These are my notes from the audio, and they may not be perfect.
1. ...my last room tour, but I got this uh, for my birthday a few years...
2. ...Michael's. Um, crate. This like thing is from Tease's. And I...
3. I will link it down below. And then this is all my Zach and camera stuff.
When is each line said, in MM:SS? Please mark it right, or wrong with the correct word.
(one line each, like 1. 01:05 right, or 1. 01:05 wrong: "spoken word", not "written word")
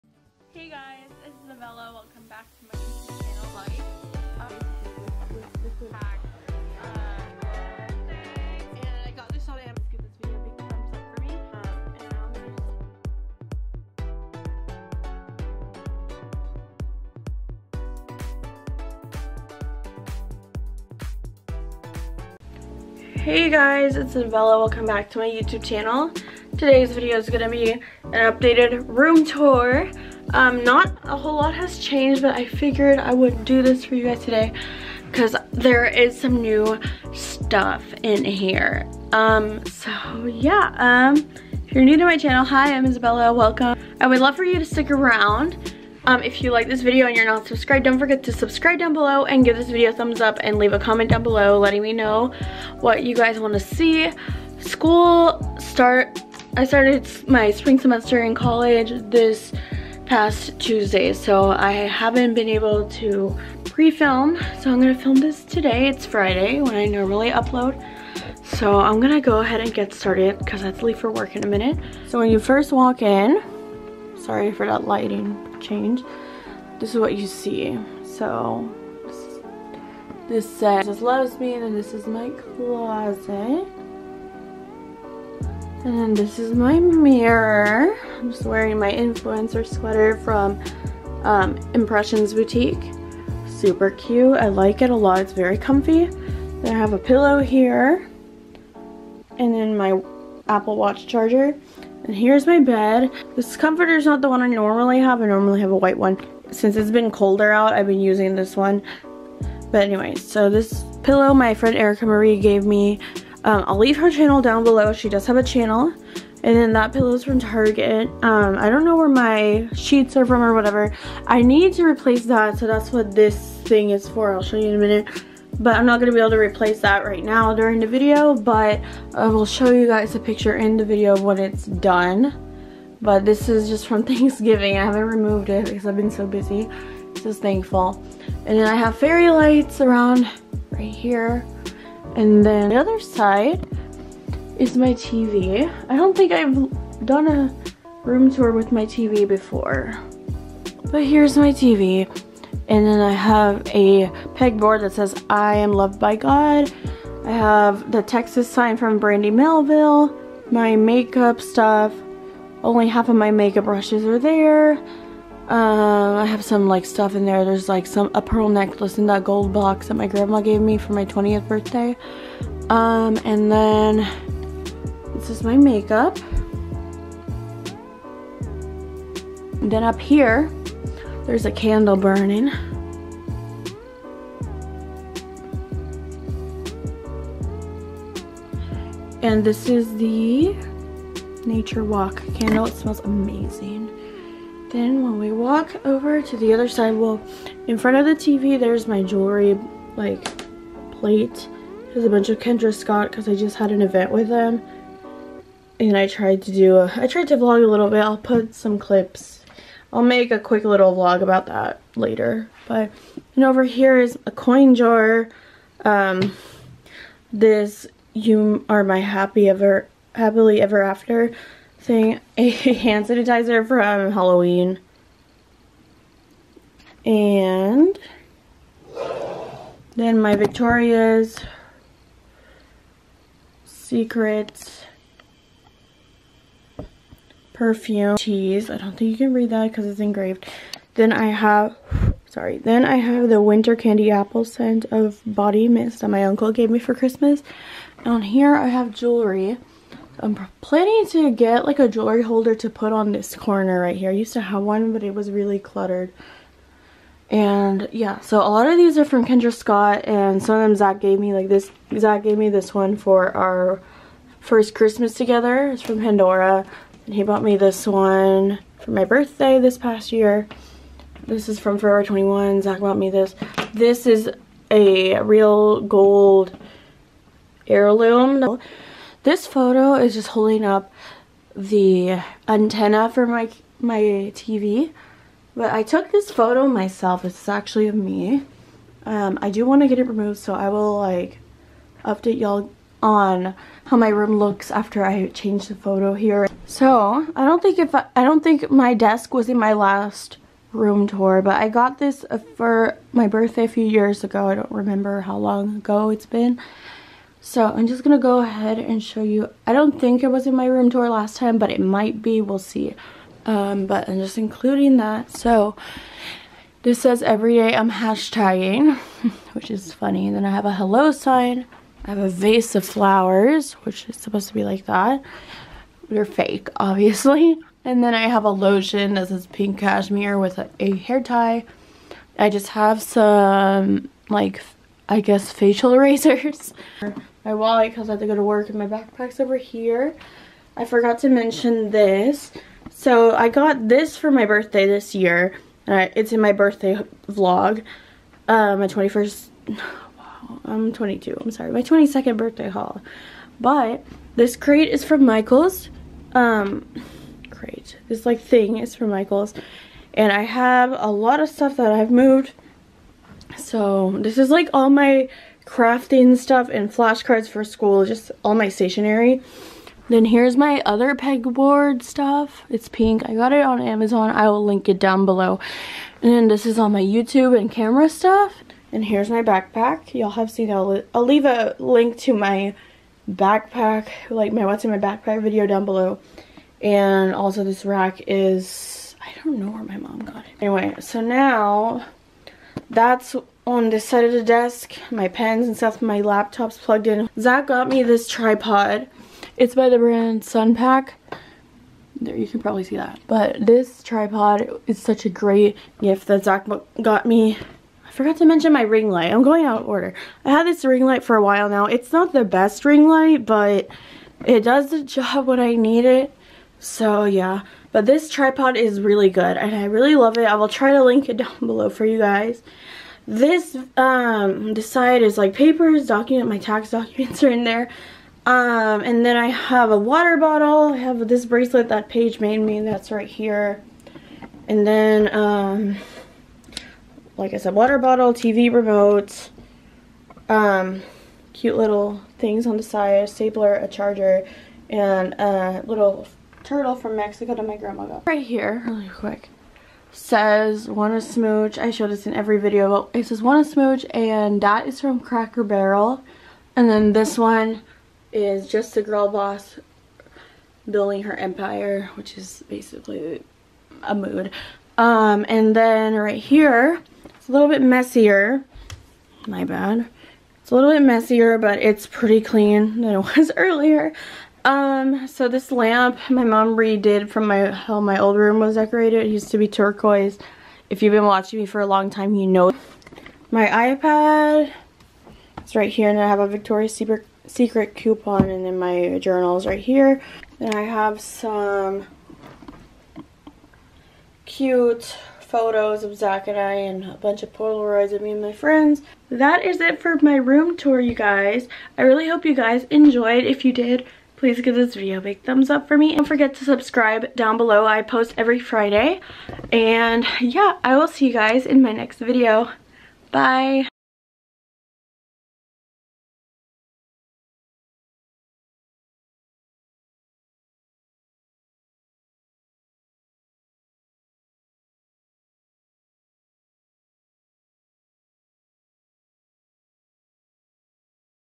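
1. 04:59 right
2. 05:55 wrong: "Michael", not "Tease"
3. 06:14 wrong: "YouTube", not "Zach".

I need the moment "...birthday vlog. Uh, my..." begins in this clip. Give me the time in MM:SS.
05:46.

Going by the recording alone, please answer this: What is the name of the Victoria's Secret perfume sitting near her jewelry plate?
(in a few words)
Tease.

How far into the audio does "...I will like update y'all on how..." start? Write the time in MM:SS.
04:50.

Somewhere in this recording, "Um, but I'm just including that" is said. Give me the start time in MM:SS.
05:13.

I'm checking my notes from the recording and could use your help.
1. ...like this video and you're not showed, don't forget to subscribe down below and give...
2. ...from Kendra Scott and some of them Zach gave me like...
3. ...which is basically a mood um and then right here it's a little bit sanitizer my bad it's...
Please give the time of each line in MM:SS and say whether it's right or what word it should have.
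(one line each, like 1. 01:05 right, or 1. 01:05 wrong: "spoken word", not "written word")
1. 00:46 wrong: "subscribed", not "showed"
2. 04:19 right
3. 07:42 wrong: "messier", not "sanitizer".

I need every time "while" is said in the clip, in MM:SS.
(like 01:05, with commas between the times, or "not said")
06:51.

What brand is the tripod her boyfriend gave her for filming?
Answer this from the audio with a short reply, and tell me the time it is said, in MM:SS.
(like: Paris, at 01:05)
Sunpak, at 06:40.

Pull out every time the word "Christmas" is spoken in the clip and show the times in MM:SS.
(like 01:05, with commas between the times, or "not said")
04:06, 04:24.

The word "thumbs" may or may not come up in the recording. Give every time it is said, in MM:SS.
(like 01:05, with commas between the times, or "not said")
00:49, 08:25.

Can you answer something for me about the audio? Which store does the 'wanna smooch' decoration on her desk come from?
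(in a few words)
Cracker Barrel.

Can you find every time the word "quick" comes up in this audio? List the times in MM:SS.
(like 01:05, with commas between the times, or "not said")
03:30, 07:29.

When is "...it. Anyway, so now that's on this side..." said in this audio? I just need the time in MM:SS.
06:30.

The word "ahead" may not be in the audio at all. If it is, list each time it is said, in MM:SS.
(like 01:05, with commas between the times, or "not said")
01:09, 05:08.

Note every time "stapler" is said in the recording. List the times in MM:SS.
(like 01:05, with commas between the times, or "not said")
07:23.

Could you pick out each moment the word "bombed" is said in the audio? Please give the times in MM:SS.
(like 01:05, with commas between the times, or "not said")
not said.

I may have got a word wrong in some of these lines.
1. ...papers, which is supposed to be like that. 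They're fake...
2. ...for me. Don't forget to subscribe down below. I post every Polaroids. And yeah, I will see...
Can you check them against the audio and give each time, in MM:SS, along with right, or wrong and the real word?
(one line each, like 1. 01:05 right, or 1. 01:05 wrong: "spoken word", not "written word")
1. 05:22 wrong: "flowers", not "papers"
2. 08:25 wrong: "Friday", not "Polaroids".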